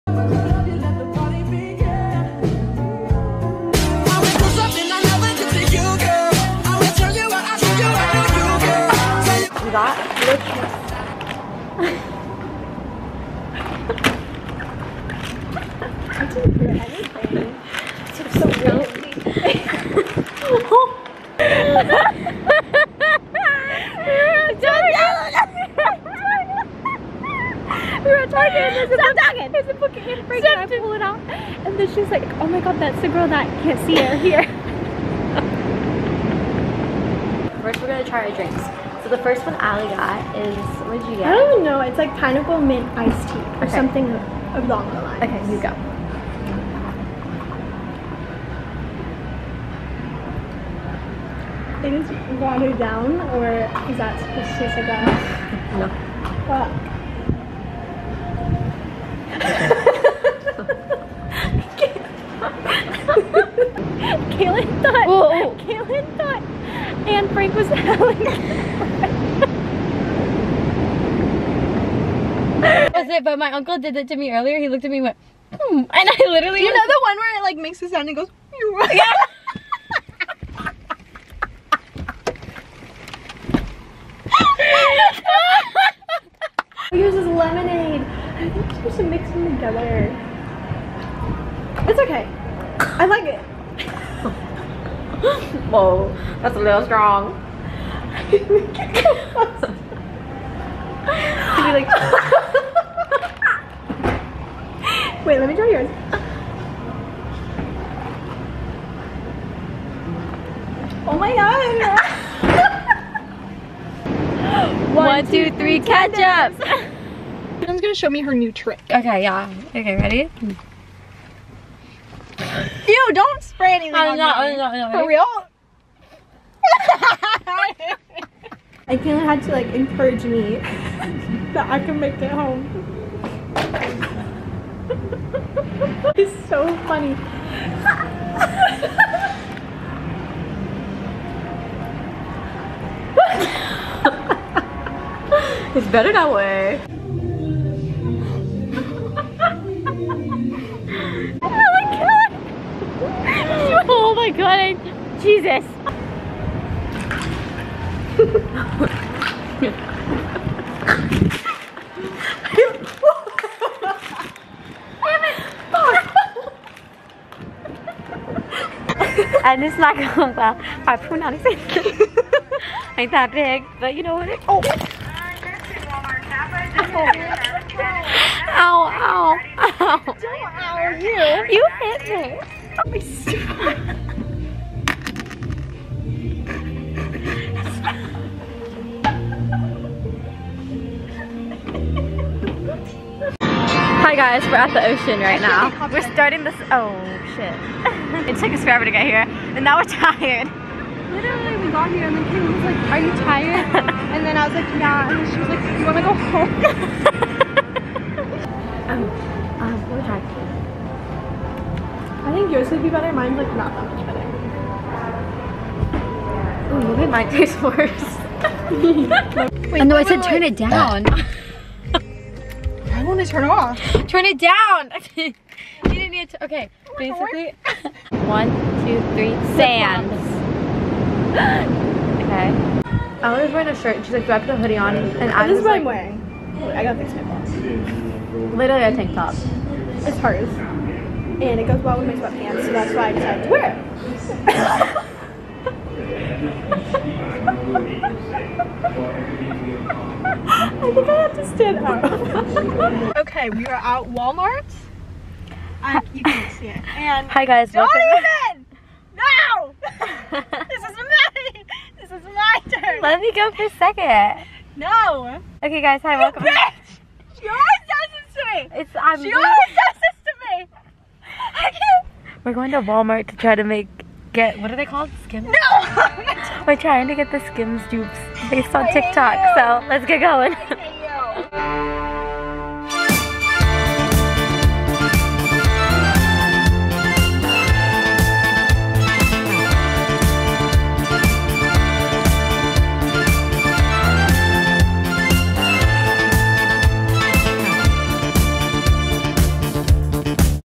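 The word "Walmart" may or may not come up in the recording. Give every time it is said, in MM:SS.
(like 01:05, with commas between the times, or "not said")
04:14, 04:32.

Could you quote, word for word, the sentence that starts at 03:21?
Literally, we got here, and then Kim was like, are you tired?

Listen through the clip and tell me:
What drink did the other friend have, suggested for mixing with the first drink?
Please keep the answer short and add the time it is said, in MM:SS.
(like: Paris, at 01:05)
lemonade, at 01:27.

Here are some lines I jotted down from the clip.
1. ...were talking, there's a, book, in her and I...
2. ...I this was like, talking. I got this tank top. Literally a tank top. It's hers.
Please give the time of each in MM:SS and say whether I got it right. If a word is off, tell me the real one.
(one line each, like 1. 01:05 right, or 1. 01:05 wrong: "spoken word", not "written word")
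1. 00:28 right
2. 03:55 wrong: "wearing", not "talking".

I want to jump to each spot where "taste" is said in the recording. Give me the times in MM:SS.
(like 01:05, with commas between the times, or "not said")
00:54, 03:37.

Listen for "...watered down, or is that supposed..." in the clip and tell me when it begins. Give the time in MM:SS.
00:52.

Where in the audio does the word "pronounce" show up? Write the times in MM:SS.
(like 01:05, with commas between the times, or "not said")
02:51.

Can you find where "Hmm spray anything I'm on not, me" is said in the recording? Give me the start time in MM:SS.
02:00.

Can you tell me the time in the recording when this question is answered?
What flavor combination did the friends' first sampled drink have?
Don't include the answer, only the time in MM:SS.
00:42.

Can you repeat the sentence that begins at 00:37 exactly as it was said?
First, we're gonna try our drinks.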